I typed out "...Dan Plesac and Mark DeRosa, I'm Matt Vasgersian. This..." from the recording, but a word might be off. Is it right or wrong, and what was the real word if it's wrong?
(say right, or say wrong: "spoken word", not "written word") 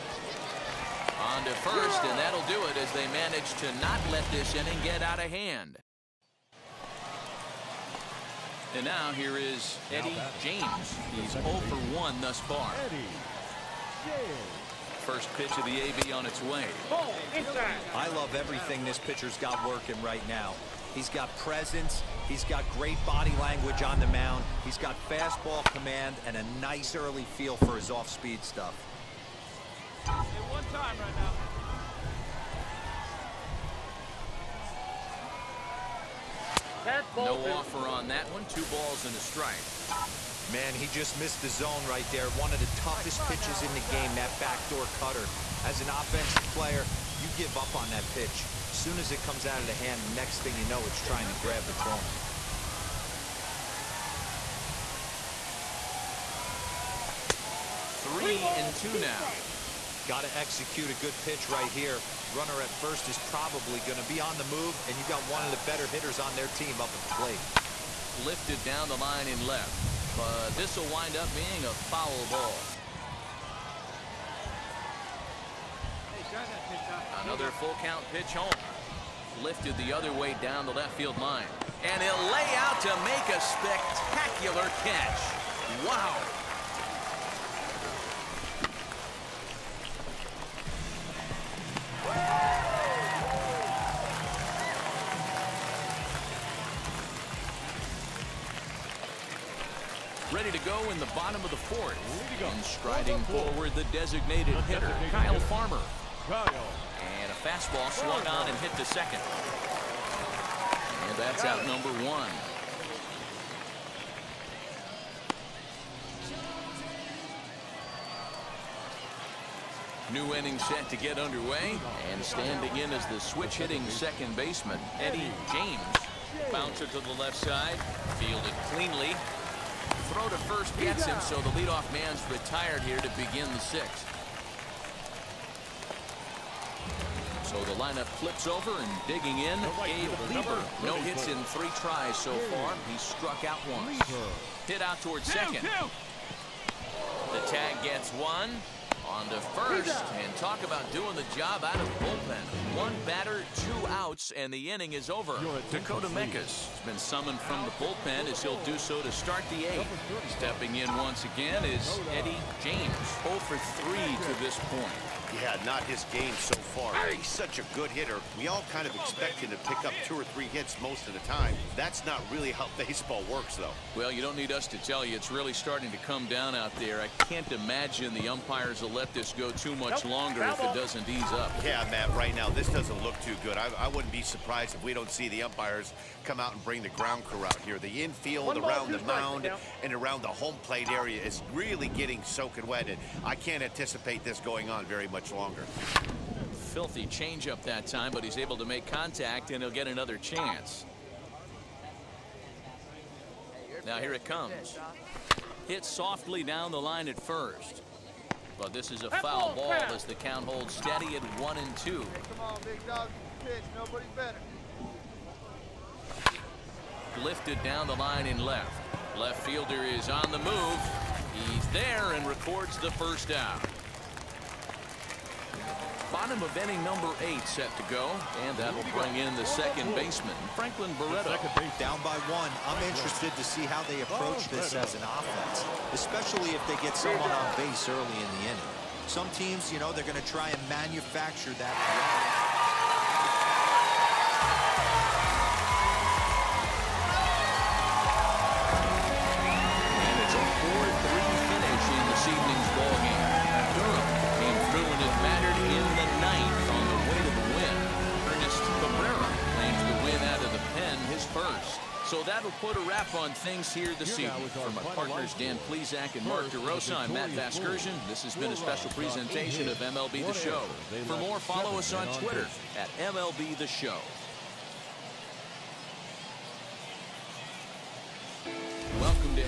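right.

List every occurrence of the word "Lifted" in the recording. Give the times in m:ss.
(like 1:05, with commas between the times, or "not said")
1:08, 1:19, 3:37.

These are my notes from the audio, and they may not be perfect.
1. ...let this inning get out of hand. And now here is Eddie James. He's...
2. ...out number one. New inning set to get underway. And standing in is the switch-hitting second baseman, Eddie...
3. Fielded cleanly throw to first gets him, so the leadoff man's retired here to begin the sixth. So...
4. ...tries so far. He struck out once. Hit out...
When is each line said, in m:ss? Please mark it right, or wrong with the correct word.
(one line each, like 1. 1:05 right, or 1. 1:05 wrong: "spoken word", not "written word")
1. 0:04 right
2. 1:51 right
3. 2:08 right
4. 2:21 right.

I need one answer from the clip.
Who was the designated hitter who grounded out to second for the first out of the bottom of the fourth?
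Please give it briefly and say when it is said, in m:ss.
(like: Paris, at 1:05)
Kyle Farmer, at 1:45.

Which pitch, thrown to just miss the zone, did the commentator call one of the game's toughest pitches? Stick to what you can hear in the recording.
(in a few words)
backdoor cutter.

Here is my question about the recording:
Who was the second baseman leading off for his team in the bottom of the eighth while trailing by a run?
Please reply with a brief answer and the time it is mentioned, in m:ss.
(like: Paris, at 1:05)
Franklin Barreto, at 3:50.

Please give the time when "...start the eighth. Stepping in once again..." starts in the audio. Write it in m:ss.
2:39.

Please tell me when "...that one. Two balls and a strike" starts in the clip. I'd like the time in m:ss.
0:38.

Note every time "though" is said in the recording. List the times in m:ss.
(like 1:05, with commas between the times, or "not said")
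2:53.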